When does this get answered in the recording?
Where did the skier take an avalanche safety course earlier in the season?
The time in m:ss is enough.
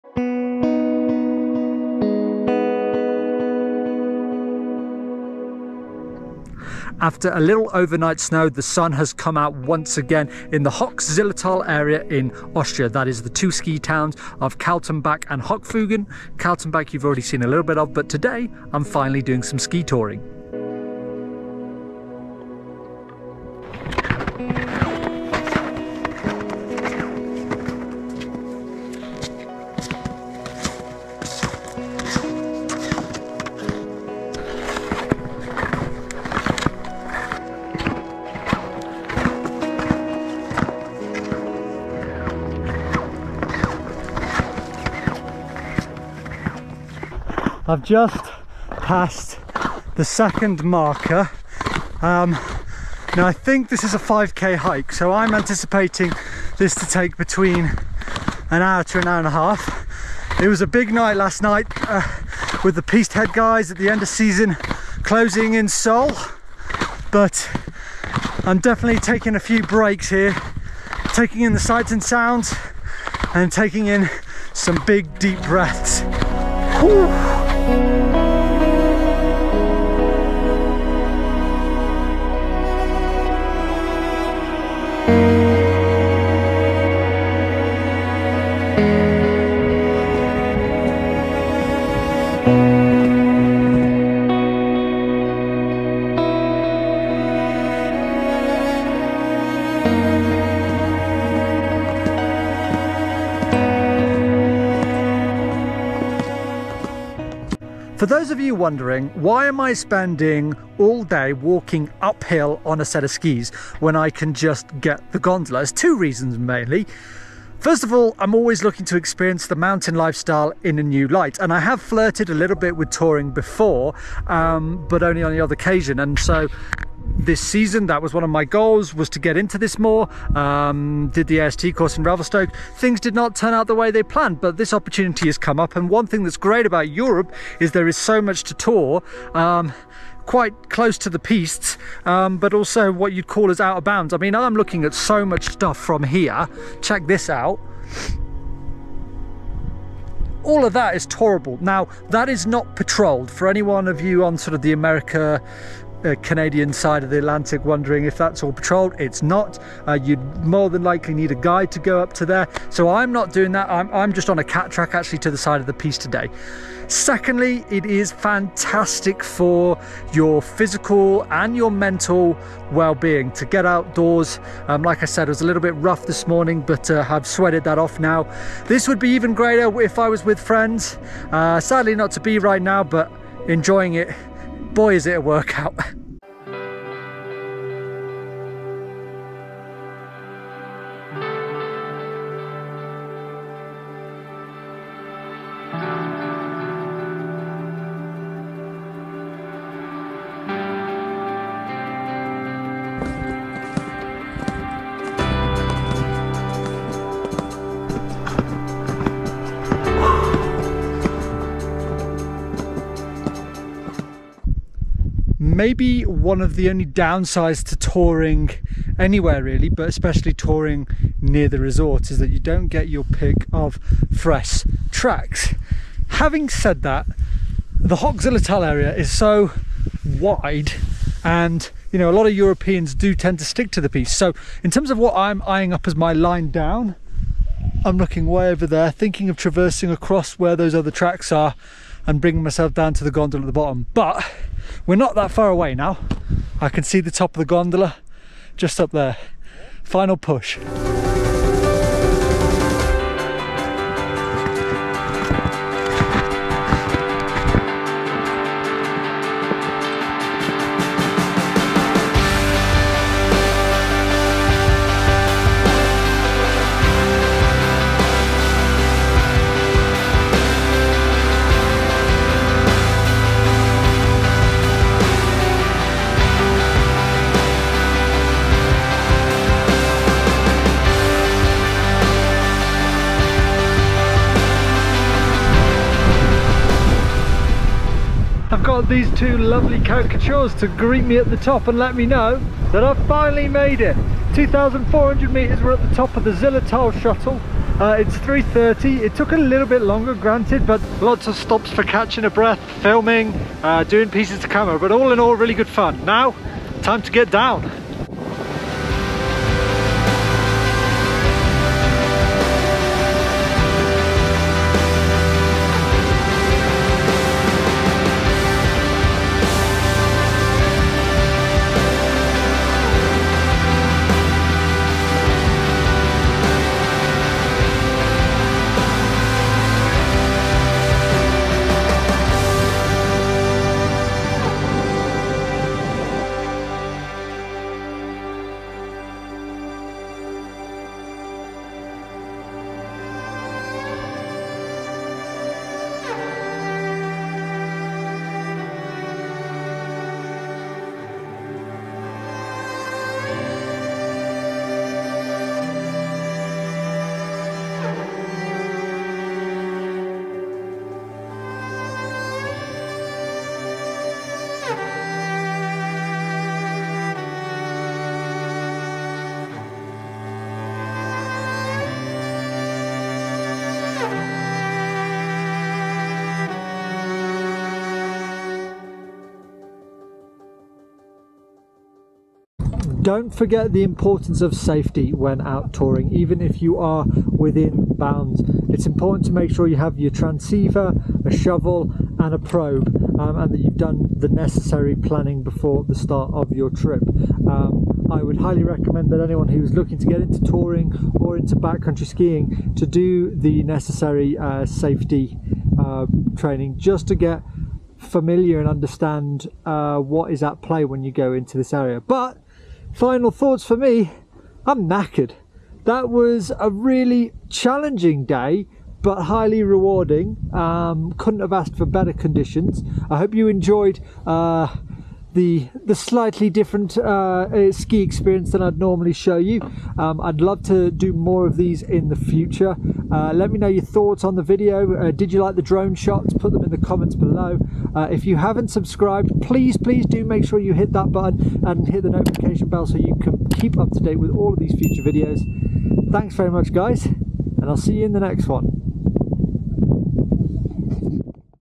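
2:12.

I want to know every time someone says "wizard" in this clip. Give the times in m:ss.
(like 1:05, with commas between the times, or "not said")
not said.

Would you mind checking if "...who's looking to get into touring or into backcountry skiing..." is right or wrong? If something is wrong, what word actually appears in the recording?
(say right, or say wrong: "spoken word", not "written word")
right.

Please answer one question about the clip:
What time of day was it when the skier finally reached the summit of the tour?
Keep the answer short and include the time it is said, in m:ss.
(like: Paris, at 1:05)
3:30, at 4:58.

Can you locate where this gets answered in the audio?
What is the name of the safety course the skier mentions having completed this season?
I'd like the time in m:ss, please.
2:11.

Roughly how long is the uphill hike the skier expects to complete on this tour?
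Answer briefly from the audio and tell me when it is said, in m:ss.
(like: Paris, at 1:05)
5k, at 0:53.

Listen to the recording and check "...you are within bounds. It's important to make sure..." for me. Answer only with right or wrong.
right.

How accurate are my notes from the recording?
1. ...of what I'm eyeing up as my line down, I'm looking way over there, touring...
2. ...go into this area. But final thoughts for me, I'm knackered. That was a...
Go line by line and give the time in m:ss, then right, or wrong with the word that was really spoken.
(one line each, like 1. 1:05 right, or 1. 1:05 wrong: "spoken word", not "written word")
1. 3:54 wrong: "thinking", not "touring"
2. 6:51 right.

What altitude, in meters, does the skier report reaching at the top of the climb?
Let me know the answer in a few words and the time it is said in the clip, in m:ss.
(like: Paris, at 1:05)
2,400 meters, at 4:54.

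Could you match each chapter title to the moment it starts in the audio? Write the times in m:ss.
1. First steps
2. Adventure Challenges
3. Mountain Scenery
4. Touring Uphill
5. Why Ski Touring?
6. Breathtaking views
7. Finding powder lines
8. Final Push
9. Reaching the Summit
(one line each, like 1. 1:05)
1. 0:20
2. 0:47
3. 1:17
4. 1:27
5. 1:47
6. 3:06
7. 3:34
8. 4:11
9. 4:45.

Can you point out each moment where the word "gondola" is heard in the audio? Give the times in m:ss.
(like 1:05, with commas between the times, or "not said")
1:55, 4:03, 4:07.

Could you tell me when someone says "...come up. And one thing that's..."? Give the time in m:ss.
2:15.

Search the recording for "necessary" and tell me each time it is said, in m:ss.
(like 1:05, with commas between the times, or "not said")
6:34, 6:43.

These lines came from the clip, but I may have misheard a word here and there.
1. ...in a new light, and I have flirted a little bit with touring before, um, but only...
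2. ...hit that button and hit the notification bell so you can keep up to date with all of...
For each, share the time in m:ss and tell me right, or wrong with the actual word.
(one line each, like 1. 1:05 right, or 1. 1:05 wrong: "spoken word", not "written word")
1. 2:00 right
2. 7:20 right.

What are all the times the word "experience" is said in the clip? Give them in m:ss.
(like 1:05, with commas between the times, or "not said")
1:58, 7:08.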